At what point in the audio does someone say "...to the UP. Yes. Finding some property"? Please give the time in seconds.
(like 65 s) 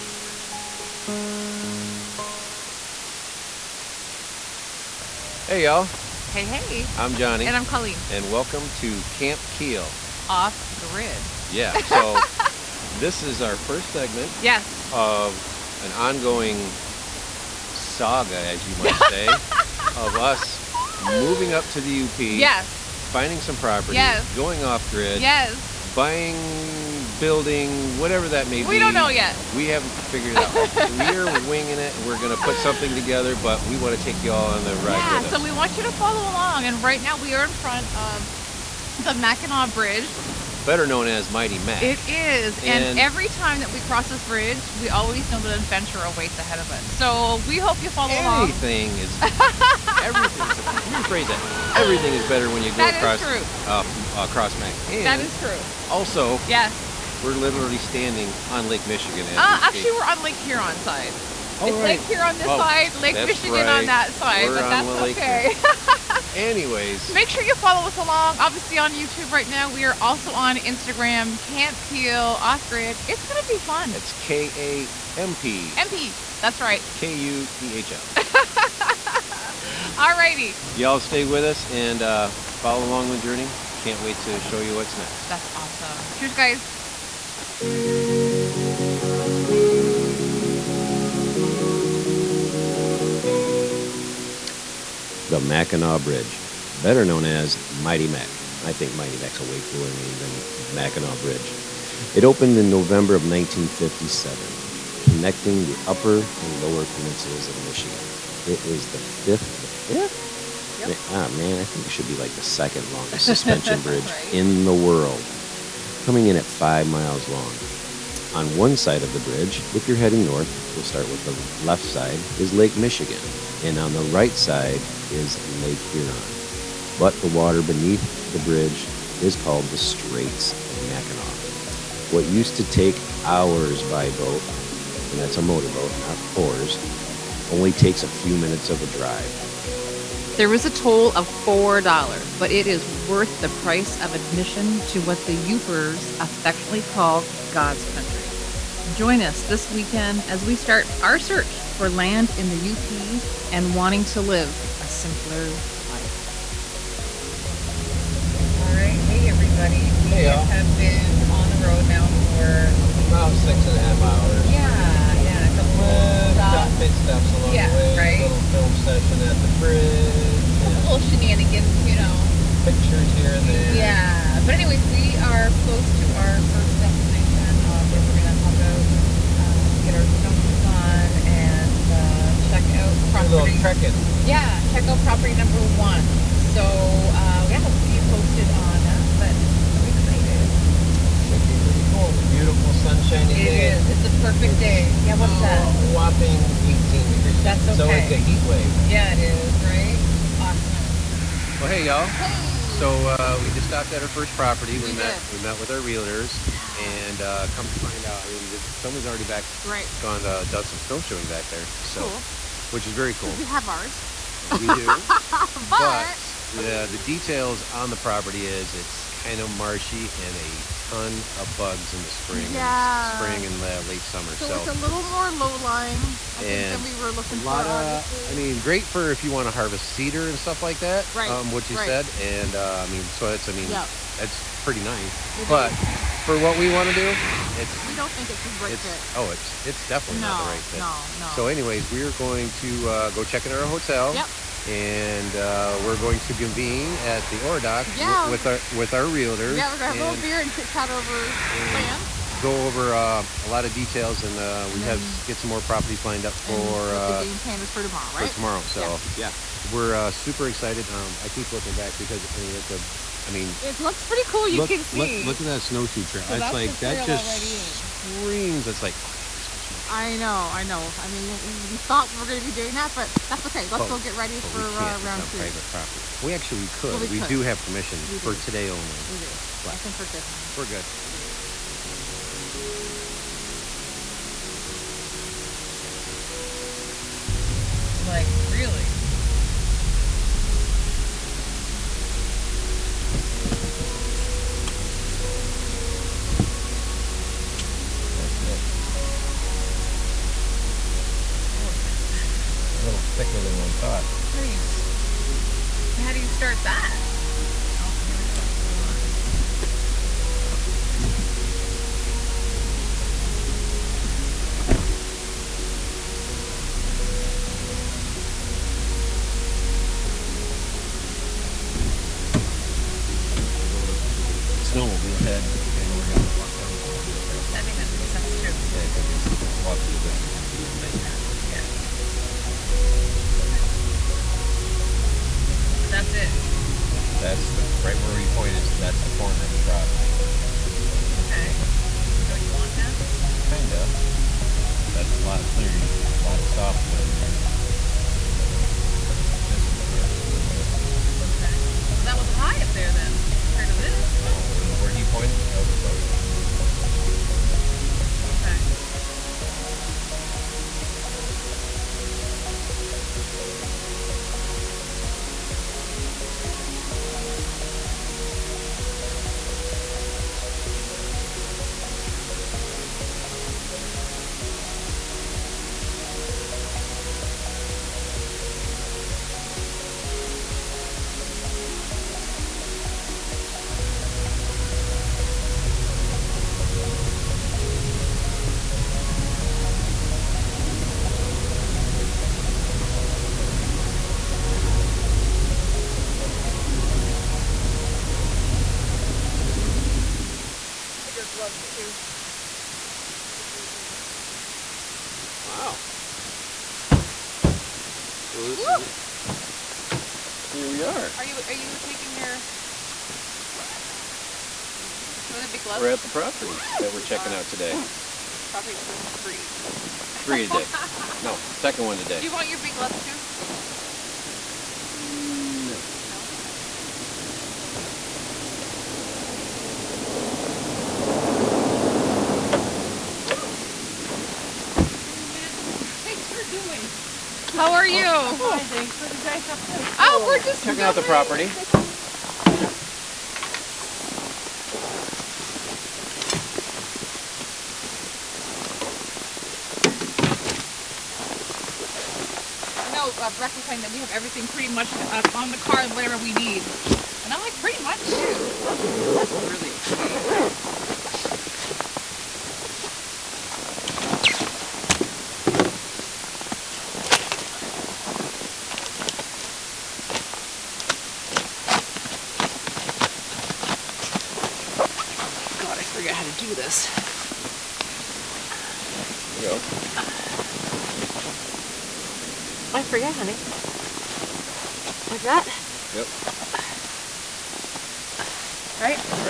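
21 s.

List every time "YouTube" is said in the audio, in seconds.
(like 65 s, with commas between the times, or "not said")
68 s.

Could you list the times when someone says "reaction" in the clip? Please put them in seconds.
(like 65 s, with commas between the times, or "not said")
not said.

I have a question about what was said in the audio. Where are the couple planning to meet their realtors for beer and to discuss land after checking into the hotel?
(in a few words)
the Ore Dock.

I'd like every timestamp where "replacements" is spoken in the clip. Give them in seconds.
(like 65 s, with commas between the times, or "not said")
not said.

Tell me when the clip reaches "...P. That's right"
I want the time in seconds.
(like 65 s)
75 s.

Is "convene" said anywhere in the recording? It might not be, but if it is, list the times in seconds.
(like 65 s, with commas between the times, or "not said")
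246 s.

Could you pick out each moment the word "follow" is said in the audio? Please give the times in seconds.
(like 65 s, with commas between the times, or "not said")
35 s, 47 s, 67 s, 82 s.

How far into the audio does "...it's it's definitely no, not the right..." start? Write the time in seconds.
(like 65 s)
239 s.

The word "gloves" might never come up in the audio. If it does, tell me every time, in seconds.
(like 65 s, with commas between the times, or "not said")
415 s, 422 s.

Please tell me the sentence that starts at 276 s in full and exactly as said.
Well, we, we do have permission do.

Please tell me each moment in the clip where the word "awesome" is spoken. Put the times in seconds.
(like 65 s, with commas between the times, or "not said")
85 s, 200 s.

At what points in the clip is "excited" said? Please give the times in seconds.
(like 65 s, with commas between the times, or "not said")
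189 s, 260 s.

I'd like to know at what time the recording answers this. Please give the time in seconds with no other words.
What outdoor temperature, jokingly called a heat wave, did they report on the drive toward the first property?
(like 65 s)
196 s.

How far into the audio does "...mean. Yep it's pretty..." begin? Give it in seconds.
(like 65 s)
233 s.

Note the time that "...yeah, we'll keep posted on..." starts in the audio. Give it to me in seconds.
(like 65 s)
187 s.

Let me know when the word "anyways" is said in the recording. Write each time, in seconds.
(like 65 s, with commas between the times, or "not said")
66 s, 174 s, 241 s.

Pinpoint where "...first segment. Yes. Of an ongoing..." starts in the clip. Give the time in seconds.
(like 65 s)
13 s.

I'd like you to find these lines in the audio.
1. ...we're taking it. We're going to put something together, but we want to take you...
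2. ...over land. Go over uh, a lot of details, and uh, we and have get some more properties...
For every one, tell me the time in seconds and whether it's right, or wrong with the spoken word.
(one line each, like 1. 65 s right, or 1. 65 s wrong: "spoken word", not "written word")
1. 31 s wrong: "winging", not "taking"
2. 250 s right.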